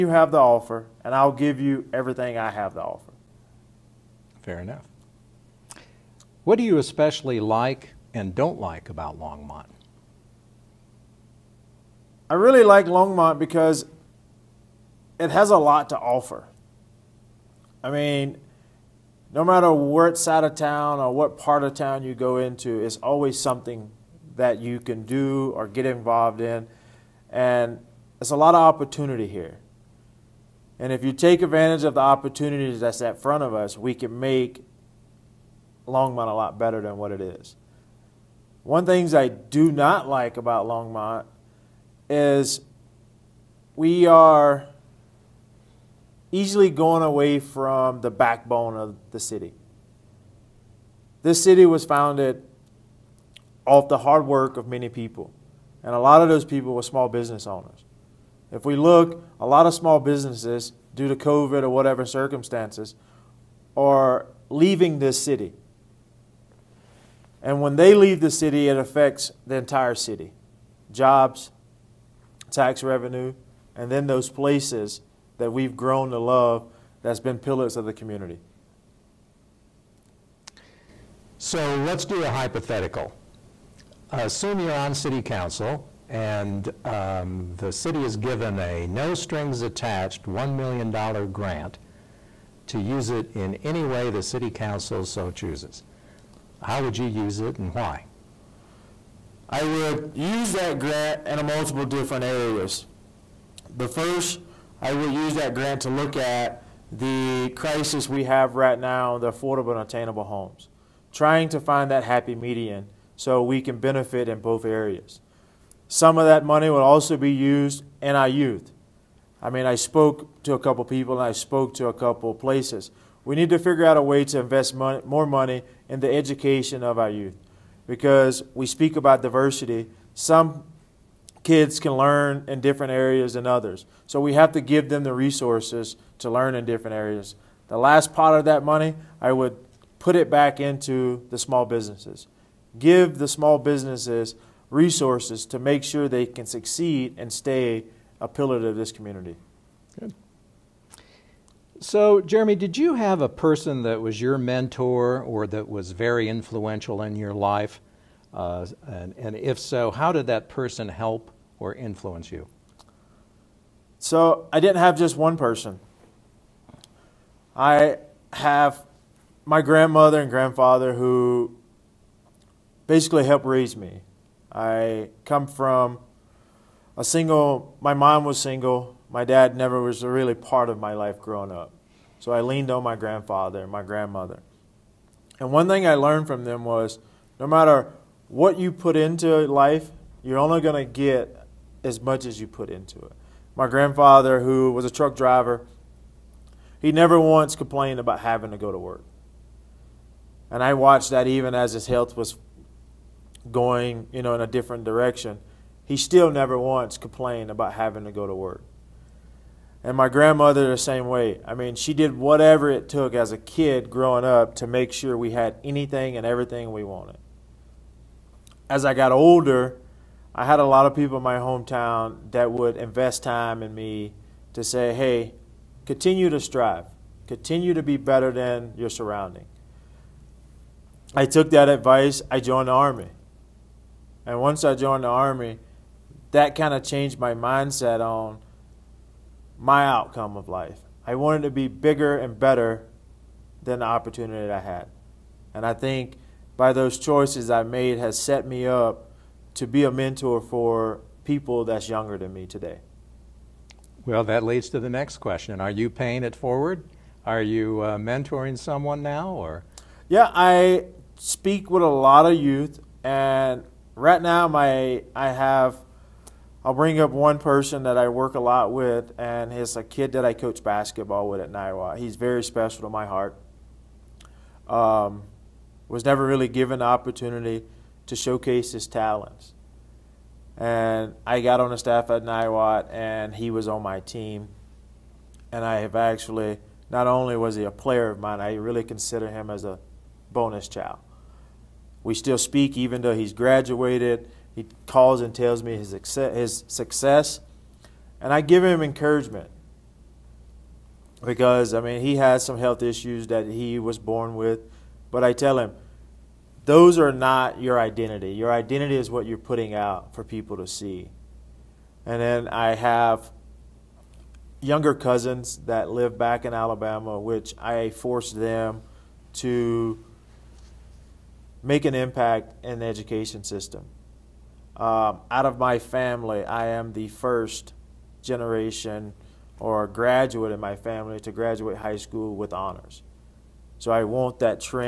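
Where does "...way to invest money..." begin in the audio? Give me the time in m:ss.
2:04.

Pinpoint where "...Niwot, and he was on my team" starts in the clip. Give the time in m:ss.
4:42.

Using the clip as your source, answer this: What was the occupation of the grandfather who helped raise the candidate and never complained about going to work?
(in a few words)
Truck driver.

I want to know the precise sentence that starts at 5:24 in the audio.
Um, out of my family, I am the first generation or graduate in my family to graduate high school with honors.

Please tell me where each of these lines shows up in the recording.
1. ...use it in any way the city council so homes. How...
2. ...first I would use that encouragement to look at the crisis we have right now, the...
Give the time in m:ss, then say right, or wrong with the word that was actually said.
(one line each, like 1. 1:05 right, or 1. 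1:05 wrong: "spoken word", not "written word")
1. 1:32 wrong: "chooses", not "homes"
2. 1:43 wrong: "grant", not "encouragement".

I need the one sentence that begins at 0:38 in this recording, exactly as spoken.
One things I do not like about Longmont is we are easily going away from the backbone of the city.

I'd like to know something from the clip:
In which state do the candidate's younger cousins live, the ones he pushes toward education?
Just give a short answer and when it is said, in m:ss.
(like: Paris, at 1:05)
Alabama, at 5:16.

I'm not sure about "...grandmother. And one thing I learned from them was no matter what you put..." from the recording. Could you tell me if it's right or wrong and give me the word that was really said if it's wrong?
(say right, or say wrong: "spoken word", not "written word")
right.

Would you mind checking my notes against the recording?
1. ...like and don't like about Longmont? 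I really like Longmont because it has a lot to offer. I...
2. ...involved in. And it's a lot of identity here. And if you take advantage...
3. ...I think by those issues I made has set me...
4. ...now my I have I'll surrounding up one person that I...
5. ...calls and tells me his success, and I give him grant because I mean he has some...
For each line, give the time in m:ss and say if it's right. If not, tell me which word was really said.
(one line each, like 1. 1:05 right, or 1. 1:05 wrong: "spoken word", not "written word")
1. 0:07 right
2. 0:25 wrong: "opportunity", not "identity"
3. 4:05 wrong: "choices", not "issues"
4. 4:24 wrong: "bring", not "surrounding"
5. 4:54 wrong: "encouragement", not "grant".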